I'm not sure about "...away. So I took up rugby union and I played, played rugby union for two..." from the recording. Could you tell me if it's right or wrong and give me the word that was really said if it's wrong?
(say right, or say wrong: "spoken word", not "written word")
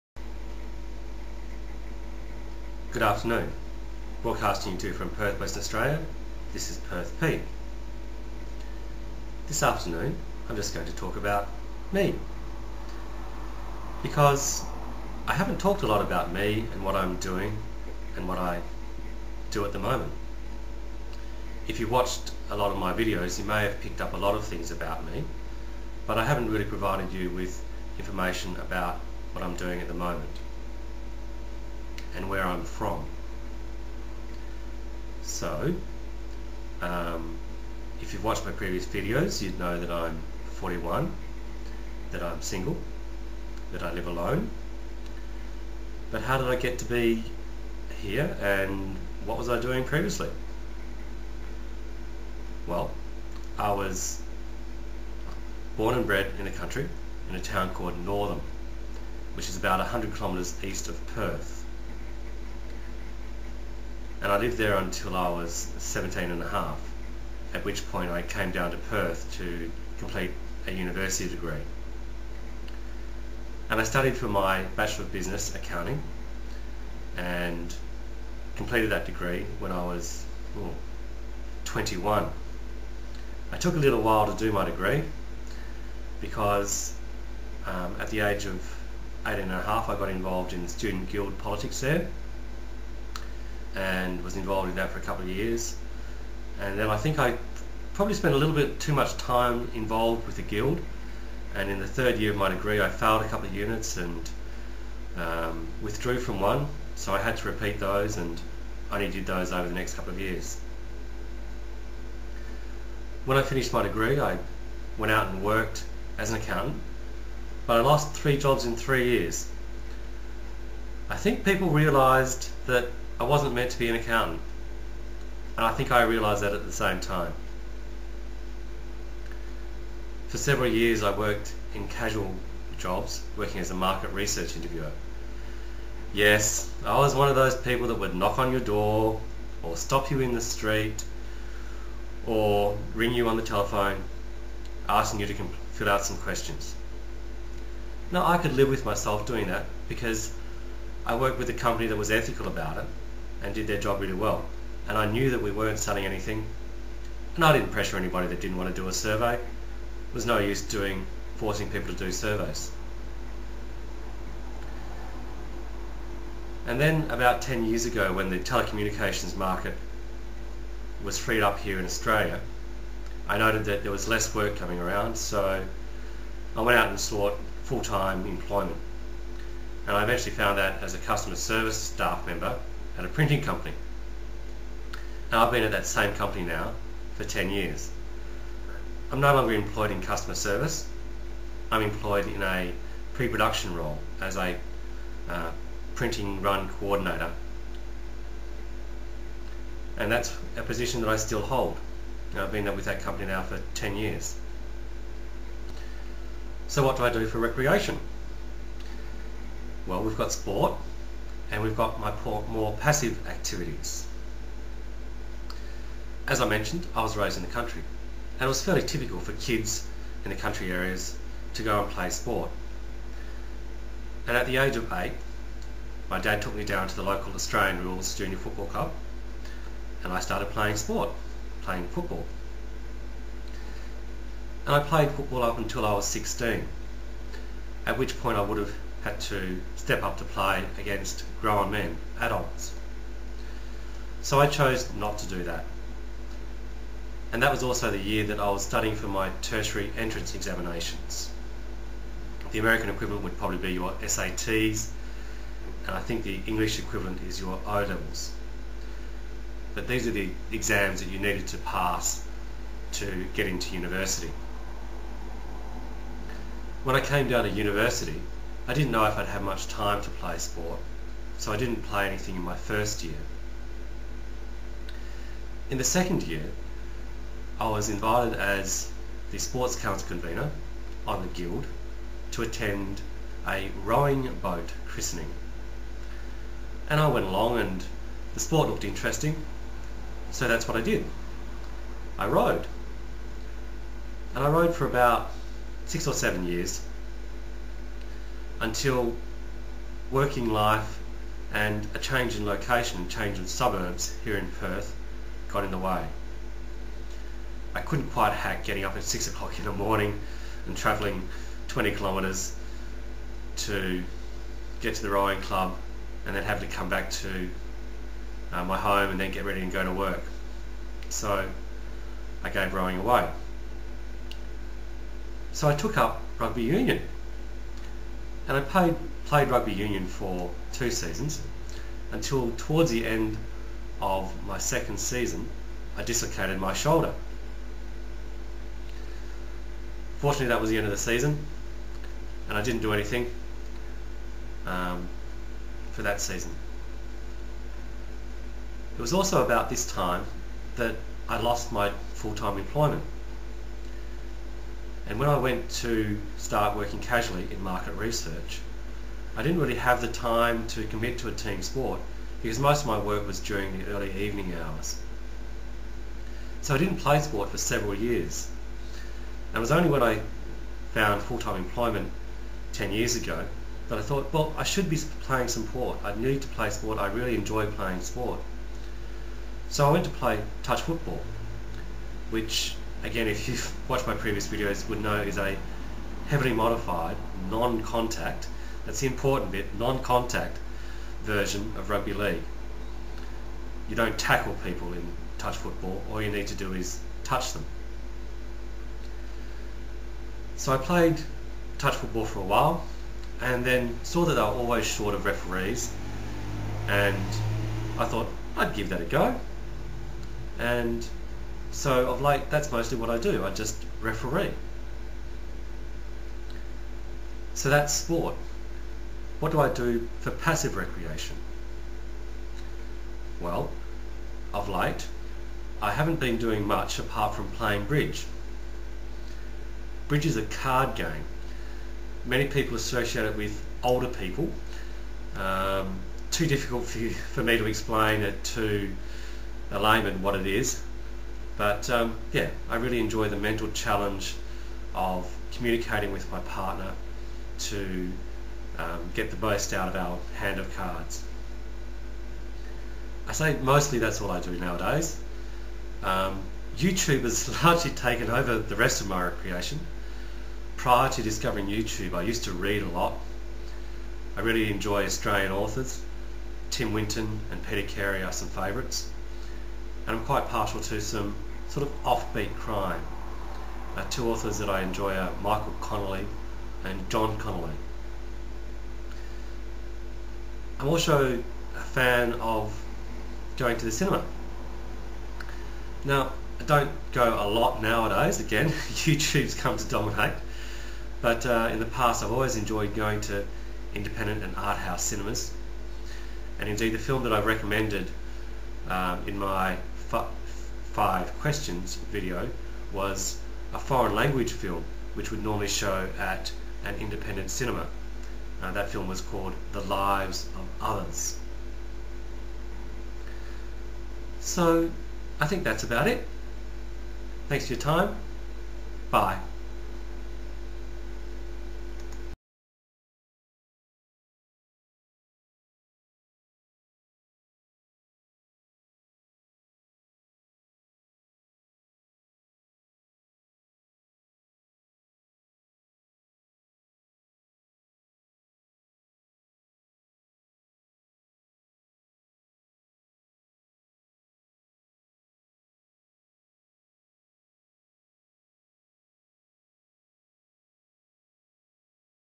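right.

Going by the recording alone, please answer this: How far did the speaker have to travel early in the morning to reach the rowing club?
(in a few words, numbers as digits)
20 kilometres.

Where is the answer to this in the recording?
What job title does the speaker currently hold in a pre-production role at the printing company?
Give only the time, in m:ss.
3:15.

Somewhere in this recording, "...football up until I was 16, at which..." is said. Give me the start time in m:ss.
3:55.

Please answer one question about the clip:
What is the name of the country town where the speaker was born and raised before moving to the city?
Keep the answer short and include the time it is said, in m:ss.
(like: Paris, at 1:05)
Northam, at 0:58.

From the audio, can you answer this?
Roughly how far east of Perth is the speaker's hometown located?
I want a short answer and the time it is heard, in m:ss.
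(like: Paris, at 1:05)
100 kilometres, at 0:59.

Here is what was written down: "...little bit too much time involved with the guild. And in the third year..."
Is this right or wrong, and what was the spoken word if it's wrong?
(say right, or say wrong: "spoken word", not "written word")
right.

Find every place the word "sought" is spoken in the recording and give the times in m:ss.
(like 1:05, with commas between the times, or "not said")
2:56.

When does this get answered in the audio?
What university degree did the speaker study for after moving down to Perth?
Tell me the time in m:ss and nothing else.
1:14.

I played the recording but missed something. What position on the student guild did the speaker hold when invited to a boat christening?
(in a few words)
sports council convener.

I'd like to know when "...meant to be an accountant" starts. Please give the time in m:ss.
2:03.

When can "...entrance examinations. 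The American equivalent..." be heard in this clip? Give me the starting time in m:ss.
4:09.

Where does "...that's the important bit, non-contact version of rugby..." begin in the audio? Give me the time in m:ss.
6:28.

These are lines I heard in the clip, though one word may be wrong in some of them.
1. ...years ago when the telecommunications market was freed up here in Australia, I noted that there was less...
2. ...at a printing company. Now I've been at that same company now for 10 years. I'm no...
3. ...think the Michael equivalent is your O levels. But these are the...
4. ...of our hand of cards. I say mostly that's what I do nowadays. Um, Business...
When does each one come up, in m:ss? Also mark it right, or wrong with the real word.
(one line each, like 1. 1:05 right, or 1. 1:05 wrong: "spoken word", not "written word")
1. 2:47 right
2. 3:02 right
3. 4:15 wrong: "English", not "Michael"
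4. 7:29 wrong: "YouTube", not "Business".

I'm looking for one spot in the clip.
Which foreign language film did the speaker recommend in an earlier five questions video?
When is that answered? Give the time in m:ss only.
8:29.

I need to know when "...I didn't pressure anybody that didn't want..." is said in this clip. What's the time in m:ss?
2:37.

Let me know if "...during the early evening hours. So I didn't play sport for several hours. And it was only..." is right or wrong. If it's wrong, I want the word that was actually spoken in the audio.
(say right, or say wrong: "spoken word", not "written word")
wrong: "years", not "hours".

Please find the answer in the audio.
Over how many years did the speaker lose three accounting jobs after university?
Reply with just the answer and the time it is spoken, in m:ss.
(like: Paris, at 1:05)
3 years, at 1:58.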